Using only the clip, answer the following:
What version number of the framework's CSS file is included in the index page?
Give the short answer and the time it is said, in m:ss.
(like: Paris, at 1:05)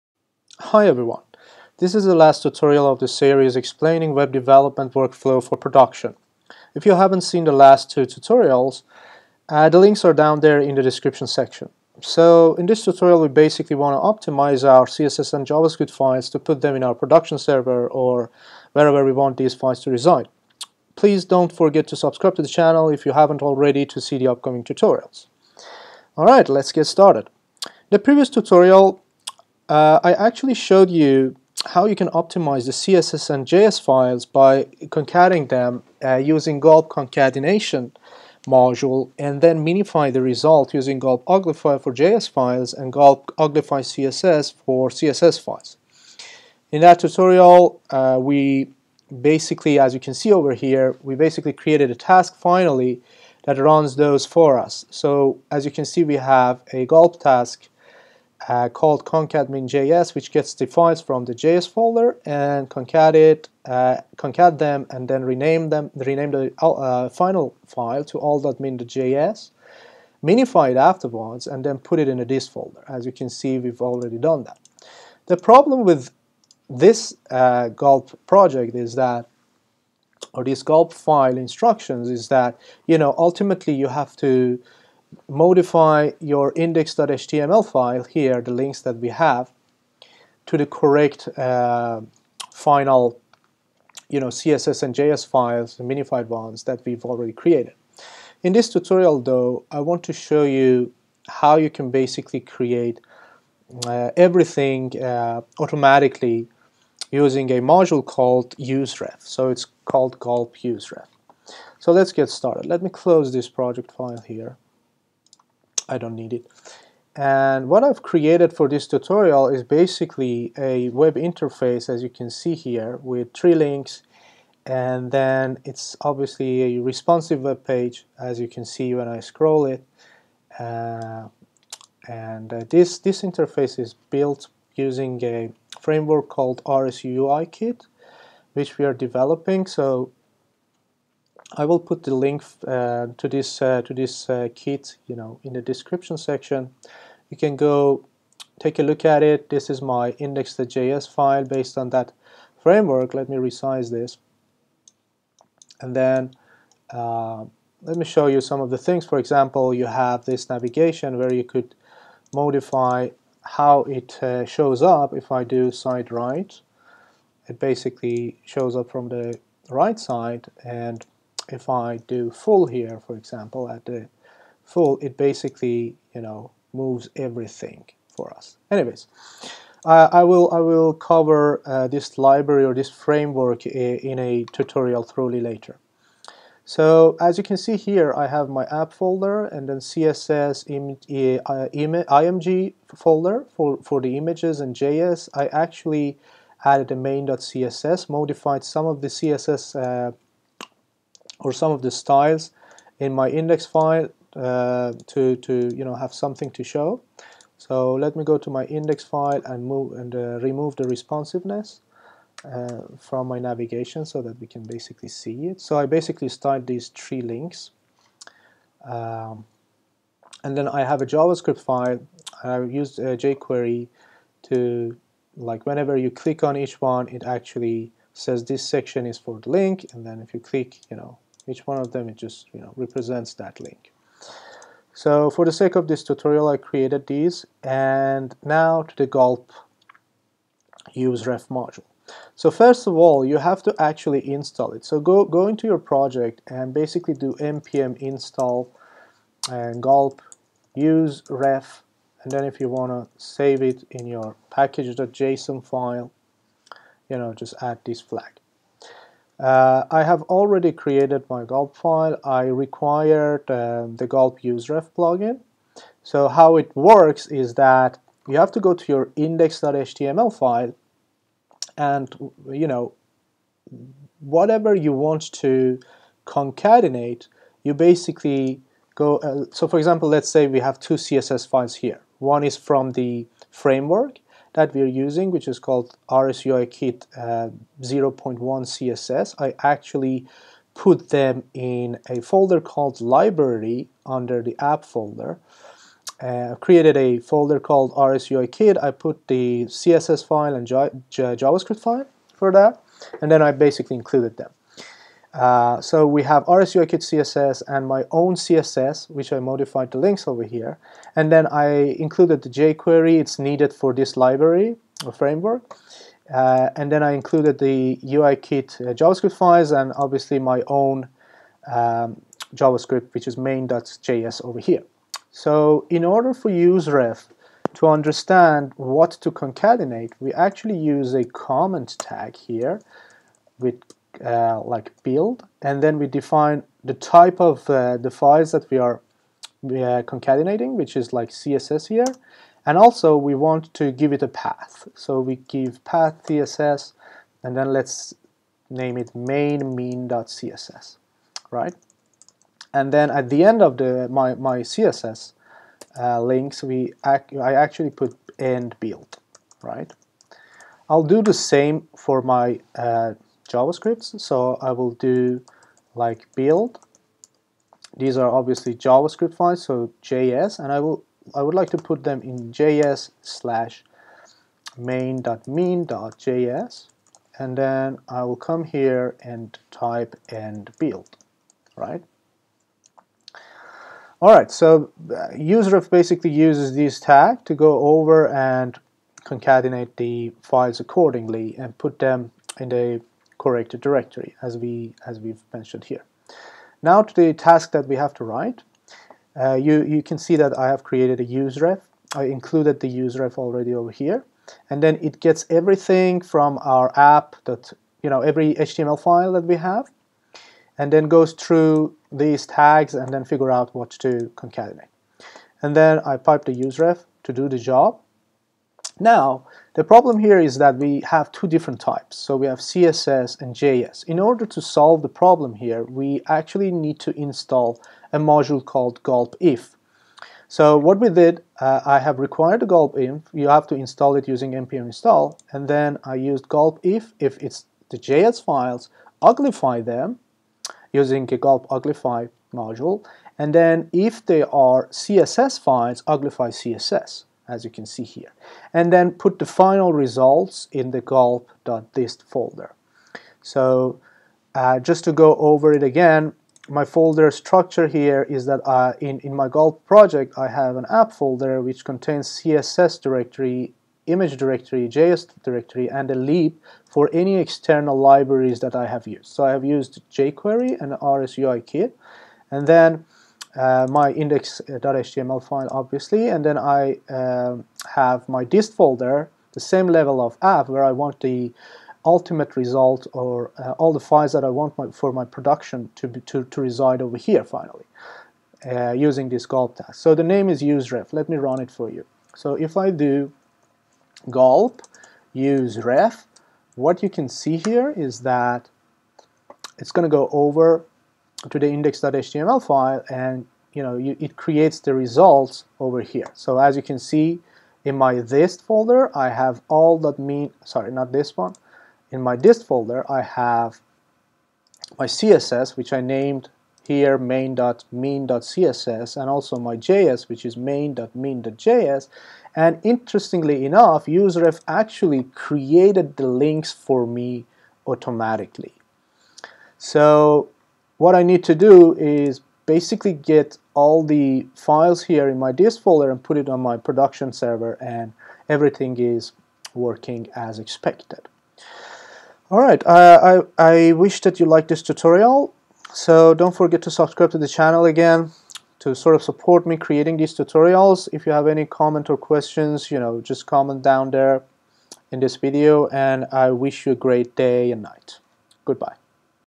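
0.1, at 4:47.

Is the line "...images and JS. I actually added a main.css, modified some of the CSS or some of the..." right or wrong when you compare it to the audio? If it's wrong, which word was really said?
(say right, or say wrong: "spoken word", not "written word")
right.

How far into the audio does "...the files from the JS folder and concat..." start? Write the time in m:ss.
1:00.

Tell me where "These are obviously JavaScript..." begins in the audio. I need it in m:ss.
6:07.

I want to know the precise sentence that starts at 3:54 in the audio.
So for the sake of this tutorial I created these and now to the gulp useref module.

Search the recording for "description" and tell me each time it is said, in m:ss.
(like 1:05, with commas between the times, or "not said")
0:10, 2:25.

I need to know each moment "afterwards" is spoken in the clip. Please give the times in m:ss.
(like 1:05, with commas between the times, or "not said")
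1:10.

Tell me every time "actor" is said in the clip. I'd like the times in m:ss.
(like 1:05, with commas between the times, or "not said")
not said.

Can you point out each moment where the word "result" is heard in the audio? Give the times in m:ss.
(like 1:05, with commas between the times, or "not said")
0:40, 7:29, 8:02, 8:24.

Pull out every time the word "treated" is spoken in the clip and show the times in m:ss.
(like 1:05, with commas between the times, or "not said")
not said.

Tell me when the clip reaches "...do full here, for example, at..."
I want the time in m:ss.
2:52.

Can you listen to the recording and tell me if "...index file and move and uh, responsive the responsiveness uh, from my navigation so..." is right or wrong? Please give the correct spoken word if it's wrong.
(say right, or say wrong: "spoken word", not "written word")
wrong: "remove", not "responsive".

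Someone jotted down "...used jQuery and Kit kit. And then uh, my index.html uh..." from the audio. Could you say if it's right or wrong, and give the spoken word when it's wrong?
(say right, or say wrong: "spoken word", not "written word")
wrong: "RSUI", not "Kit".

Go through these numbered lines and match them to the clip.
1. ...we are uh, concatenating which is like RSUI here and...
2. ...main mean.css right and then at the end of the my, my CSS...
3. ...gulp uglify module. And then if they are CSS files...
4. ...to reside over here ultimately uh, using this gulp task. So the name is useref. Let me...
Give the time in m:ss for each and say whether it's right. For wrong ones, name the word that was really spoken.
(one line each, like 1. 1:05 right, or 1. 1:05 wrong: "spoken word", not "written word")
1. 5:38 wrong: "CSS", not "RSUI"
2. 5:49 right
3. 7:21 right
4. 8:06 wrong: "finally", not "ultimately".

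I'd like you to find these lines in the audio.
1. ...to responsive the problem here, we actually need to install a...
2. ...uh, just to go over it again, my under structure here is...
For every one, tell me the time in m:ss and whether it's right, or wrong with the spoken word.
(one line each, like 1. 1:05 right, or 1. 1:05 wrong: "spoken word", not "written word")
1. 7:04 wrong: "solve", not "responsive"
2. 7:34 wrong: "folder", not "under".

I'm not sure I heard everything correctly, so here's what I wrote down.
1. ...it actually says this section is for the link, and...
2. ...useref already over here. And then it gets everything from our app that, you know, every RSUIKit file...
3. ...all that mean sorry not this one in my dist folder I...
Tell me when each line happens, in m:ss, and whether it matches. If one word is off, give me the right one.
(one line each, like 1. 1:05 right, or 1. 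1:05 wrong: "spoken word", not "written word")
1. 3:47 right
2. 6:43 wrong: "HTML", not "RSUIKit"
3. 8:29 right.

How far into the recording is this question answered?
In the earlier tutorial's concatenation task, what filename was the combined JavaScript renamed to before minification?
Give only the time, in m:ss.
1:08.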